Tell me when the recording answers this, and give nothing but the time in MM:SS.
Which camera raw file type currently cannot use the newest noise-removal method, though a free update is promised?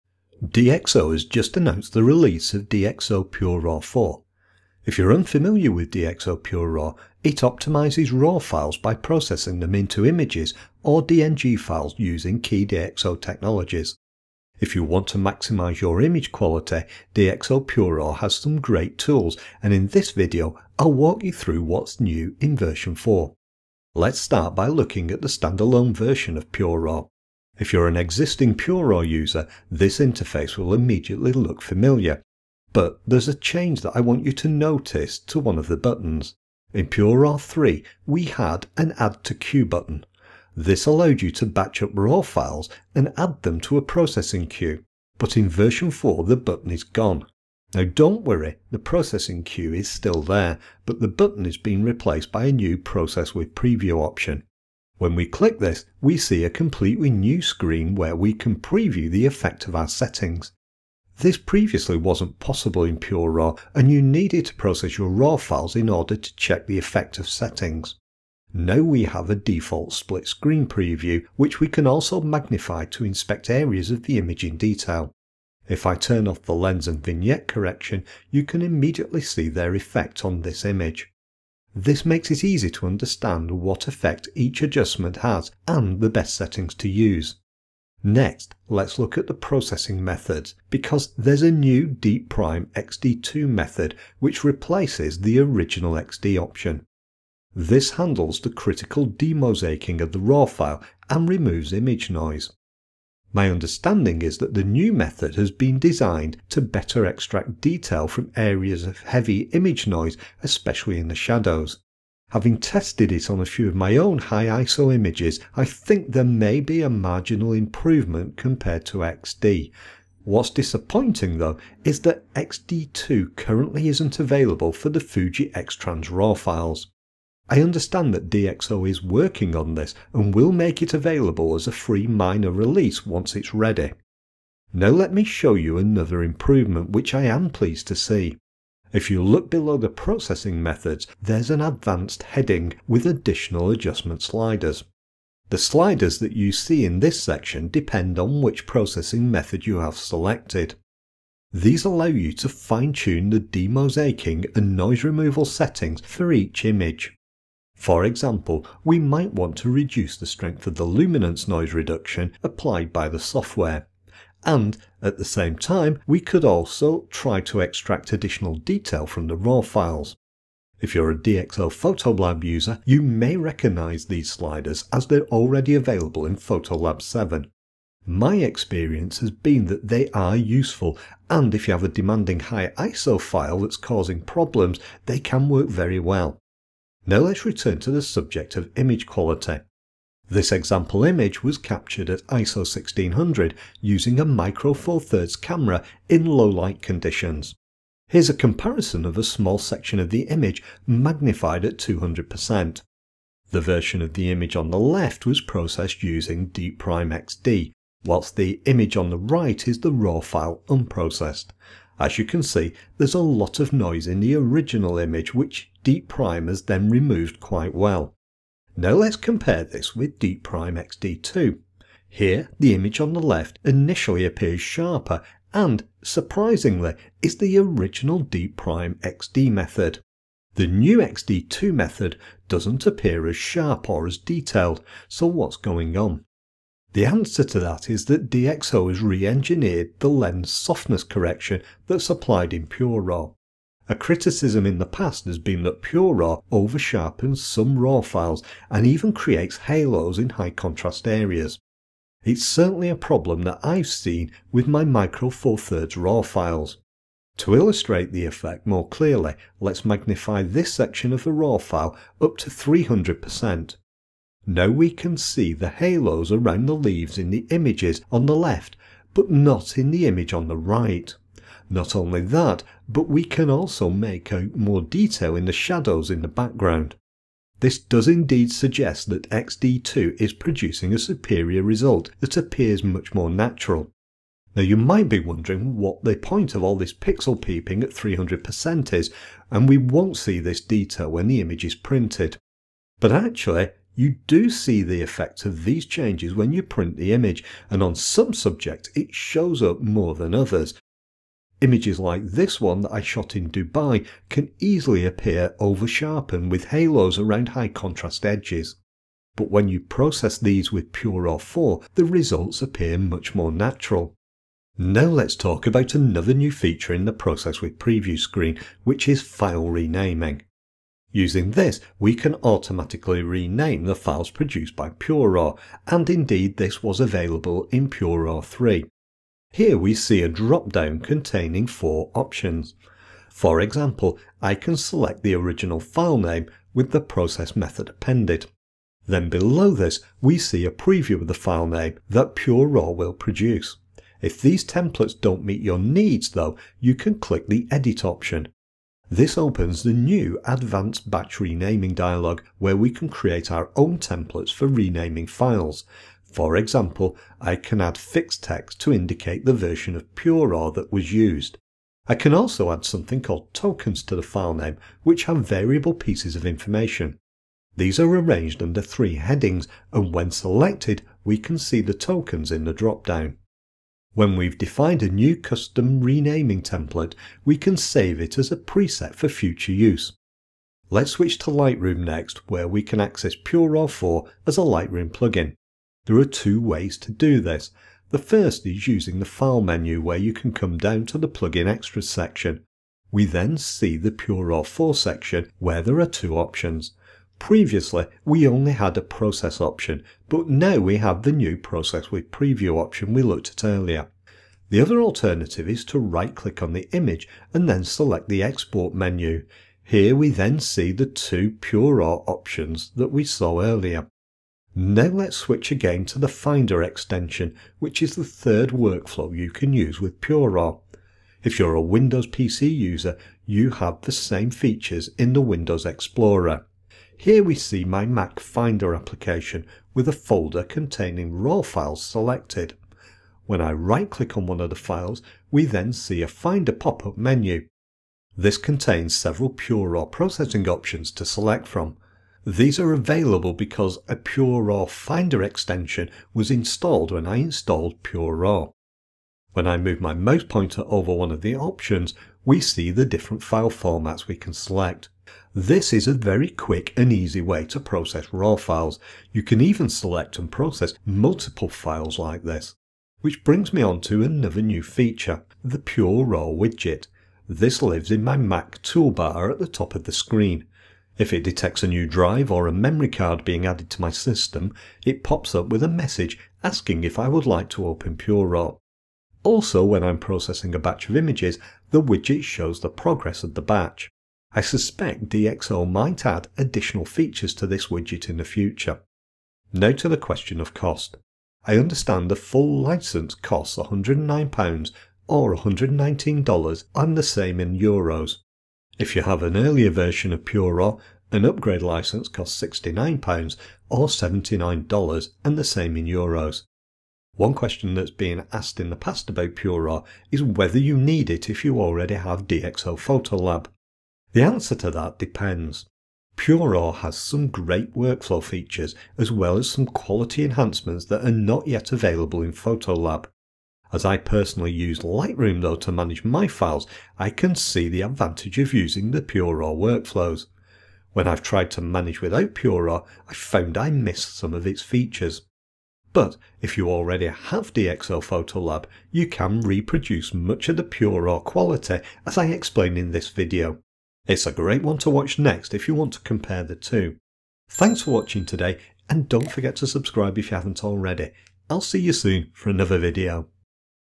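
02:04.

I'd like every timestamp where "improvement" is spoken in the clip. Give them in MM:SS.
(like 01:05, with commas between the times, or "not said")
01:57, 02:16.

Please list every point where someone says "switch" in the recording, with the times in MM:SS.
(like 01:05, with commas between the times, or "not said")
06:21, 06:55.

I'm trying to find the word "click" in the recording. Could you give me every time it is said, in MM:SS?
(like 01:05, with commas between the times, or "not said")
00:55, 05:47, 06:46, 07:14.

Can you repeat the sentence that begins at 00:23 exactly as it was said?
Let's start by looking at the standalone version of Pure Raw.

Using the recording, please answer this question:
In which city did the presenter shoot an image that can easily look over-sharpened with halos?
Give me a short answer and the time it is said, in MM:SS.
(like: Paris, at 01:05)
Dubai, at 05:03.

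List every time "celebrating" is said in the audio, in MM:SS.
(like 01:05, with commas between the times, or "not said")
not said.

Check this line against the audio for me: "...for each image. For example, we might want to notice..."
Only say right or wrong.
wrong.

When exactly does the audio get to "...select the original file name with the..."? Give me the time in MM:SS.
05:34.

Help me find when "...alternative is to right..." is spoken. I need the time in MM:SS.
06:45.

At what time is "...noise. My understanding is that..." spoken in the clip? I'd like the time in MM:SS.
01:42.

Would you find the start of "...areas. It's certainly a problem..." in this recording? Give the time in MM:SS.
04:11.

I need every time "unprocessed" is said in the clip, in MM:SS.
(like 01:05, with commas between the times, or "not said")
03:30.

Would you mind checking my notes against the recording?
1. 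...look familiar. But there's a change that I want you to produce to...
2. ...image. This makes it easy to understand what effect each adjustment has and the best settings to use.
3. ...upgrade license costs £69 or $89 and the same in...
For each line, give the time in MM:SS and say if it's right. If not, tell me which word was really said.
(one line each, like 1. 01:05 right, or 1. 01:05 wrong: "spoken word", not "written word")
1. 00:31 wrong: "notice", not "produce"
2. 01:20 right
3. 08:21 wrong: "79", not "89".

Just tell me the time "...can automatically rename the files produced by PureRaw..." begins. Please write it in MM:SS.
05:22.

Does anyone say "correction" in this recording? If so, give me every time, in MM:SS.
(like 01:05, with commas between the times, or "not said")
01:17, 04:01.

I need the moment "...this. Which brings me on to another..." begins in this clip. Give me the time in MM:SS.
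07:42.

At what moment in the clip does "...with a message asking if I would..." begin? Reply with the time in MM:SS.
07:55.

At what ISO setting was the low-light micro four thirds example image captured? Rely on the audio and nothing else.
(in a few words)
1600.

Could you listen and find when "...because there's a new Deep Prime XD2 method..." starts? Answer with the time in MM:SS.
01:30.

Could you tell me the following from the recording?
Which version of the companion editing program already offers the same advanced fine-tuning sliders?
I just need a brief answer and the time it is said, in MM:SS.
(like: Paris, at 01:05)
Photolab 7, at 02:56.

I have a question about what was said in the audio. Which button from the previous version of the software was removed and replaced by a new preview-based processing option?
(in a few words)
Add to Queue.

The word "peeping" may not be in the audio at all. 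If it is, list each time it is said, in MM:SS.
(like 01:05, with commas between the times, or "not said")
04:47.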